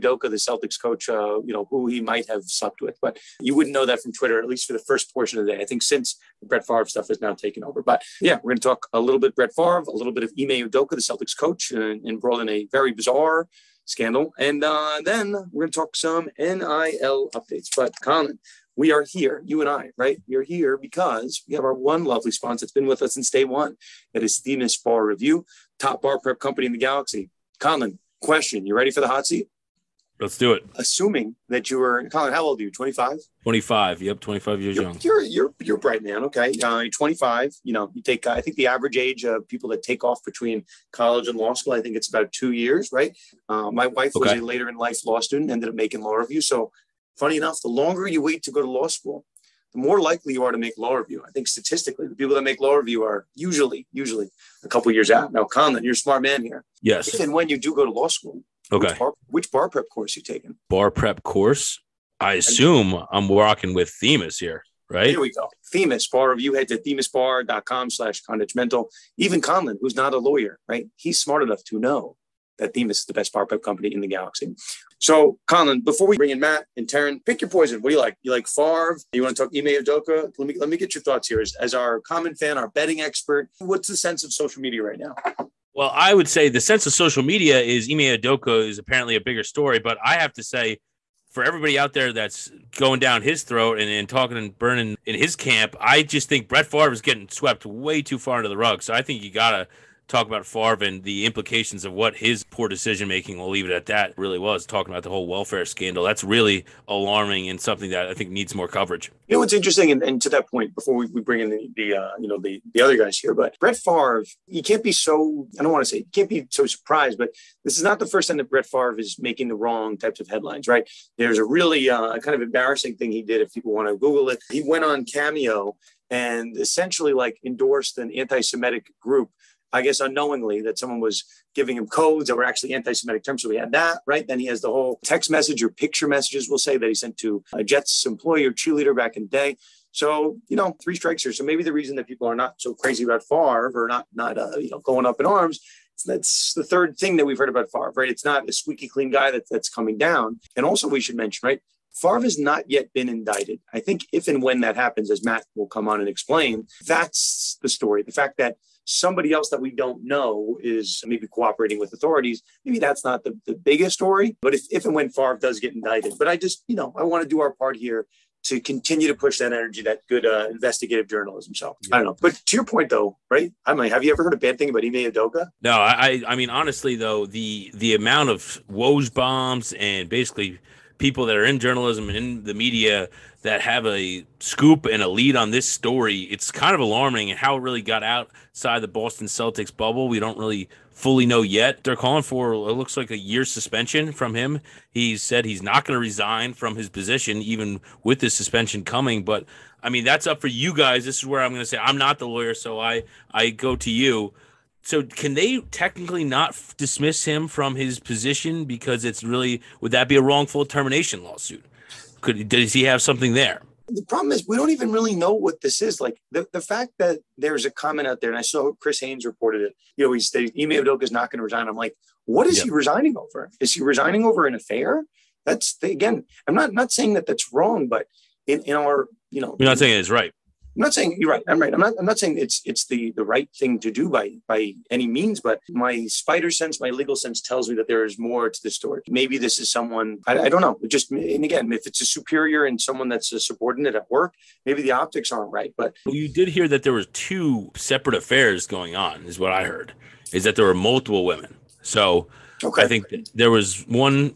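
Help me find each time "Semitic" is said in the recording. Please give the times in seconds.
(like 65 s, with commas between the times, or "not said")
128 s, 132 s.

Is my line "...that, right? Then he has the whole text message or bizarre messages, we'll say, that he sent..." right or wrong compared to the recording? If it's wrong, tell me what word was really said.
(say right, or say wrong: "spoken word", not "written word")
wrong: "picture", not "bizarre".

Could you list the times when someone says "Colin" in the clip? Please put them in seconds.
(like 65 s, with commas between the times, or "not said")
18 s, 27 s, 32 s, 75 s.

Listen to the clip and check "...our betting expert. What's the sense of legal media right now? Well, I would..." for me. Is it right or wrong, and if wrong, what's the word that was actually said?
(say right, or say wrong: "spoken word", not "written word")
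wrong: "social", not "legal".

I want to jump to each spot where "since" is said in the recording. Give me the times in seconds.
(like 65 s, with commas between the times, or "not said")
5 s, 23 s.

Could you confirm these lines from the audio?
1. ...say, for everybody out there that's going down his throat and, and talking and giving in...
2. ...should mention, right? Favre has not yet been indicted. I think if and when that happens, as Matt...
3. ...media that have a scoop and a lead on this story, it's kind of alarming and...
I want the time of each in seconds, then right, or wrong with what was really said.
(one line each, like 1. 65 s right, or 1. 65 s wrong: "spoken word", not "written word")
1. 90 s wrong: "burning", not "giving"
2. 151 s right
3. 182 s right.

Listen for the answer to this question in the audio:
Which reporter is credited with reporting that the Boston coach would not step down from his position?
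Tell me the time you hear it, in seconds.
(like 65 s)
218 s.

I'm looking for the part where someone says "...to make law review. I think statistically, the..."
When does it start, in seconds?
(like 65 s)
50 s.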